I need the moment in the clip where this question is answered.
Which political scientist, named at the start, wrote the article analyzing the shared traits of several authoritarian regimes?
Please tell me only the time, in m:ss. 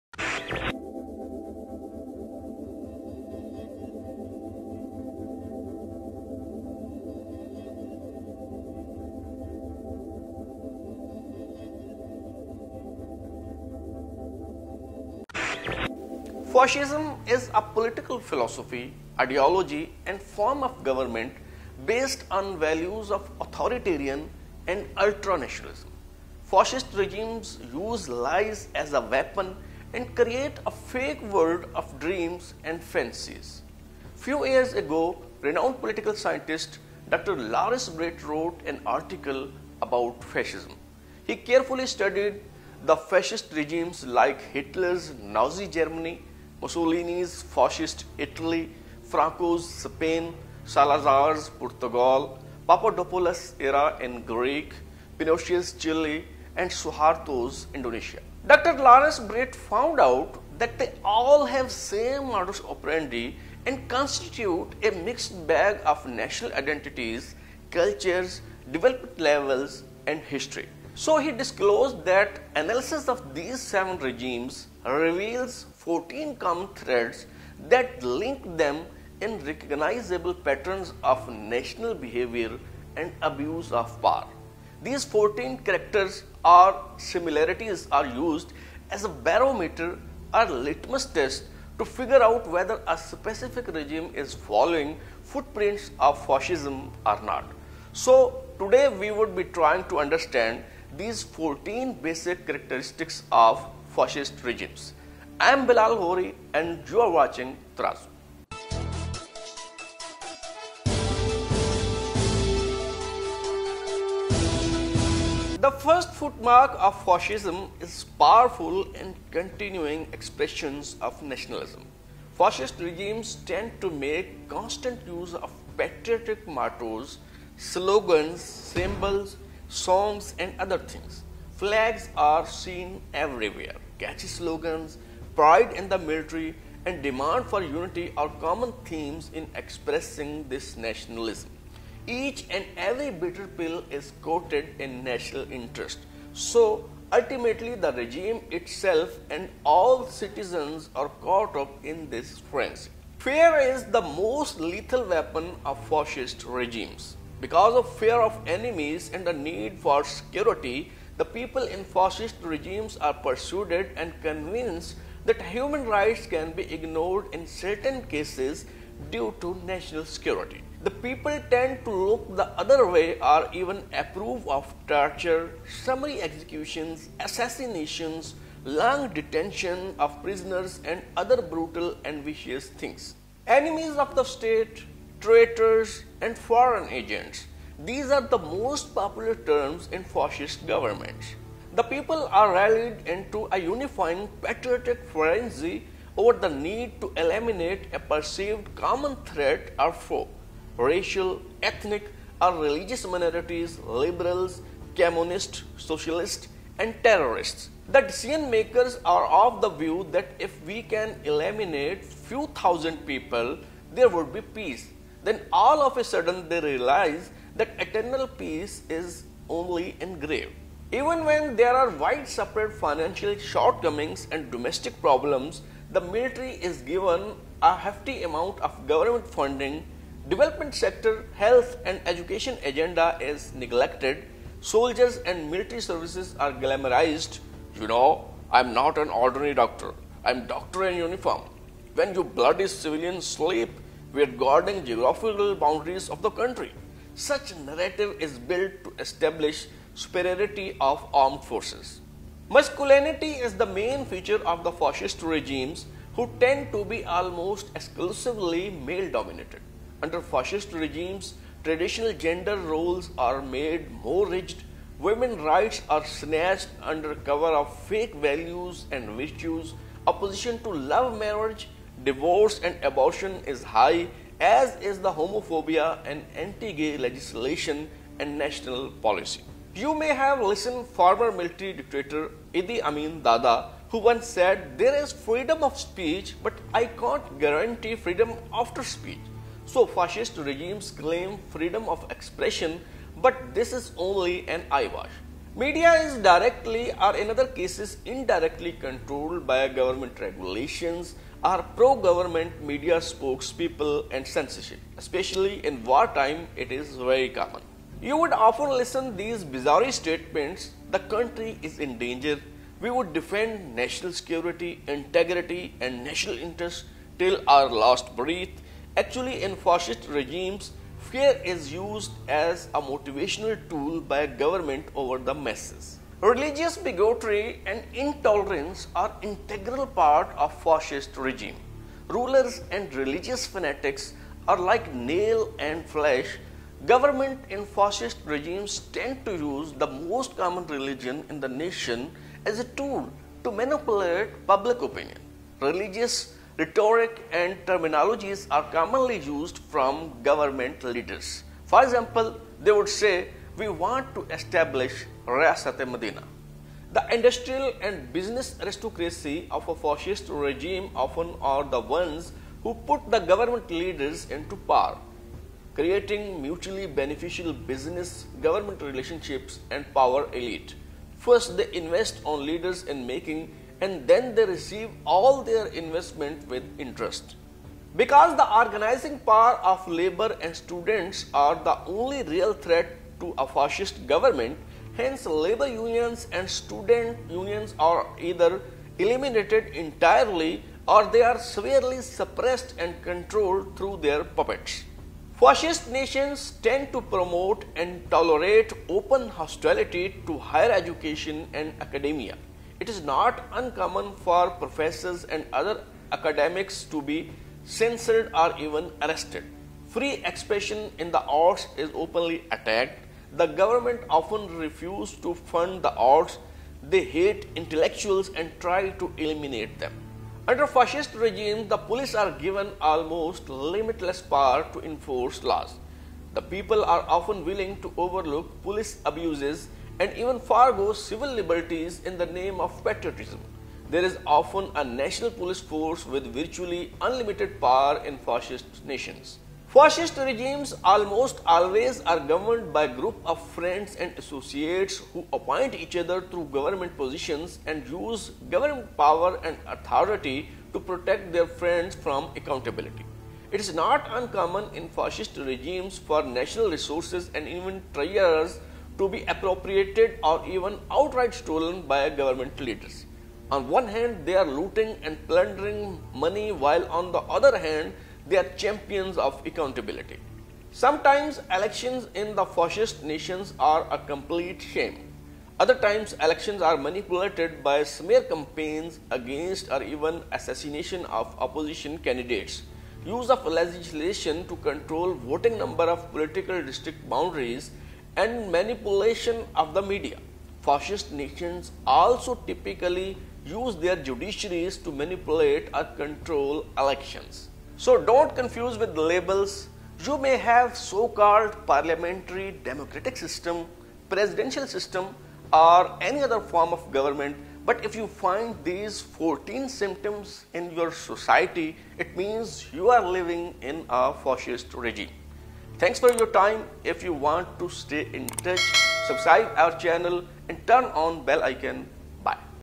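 0:37.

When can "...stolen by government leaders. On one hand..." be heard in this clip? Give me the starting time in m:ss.
7:41.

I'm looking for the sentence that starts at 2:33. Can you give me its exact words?
Fear is the most lethal weapon of fascist regimes.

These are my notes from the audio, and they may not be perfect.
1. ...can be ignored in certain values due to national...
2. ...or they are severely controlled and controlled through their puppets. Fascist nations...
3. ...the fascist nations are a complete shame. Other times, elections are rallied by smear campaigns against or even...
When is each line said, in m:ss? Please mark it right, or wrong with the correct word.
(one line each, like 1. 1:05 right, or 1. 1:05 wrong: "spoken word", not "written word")
1. 2:46 wrong: "cases", not "values"
2. 6:30 wrong: "suppressed", not "controlled"
3. 7:52 wrong: "manipulated", not "rallied".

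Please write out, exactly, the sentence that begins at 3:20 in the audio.
Racial, ethnic, or religious minorities, liberals, communists, socialists, and terrorists.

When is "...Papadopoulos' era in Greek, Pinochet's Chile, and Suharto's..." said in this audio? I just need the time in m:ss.
0:52.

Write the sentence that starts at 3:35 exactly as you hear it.
Then all of a sudden they realize that eternal peace is only engraved.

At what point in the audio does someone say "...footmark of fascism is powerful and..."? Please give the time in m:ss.
1:56.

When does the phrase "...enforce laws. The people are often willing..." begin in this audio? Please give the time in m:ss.
7:04.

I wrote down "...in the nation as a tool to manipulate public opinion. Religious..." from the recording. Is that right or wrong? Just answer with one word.
right.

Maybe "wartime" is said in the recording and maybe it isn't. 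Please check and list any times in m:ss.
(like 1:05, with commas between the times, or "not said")
5:05.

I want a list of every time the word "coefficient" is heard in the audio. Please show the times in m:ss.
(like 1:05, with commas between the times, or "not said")
not said.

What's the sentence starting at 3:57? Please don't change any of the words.
You know, I'm not an ordinary doctor.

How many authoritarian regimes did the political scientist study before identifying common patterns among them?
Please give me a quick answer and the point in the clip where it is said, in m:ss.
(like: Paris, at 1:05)
7, at 1:13.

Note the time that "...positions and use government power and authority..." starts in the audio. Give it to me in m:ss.
7:26.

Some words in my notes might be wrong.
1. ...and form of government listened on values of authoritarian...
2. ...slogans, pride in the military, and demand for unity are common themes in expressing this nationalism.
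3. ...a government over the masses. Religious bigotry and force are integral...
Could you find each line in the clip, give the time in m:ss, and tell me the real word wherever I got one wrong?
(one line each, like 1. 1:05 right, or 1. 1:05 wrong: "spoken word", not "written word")
1. 0:20 wrong: "based", not "listened"
2. 2:14 right
3. 5:24 wrong: "intolerance", not "force".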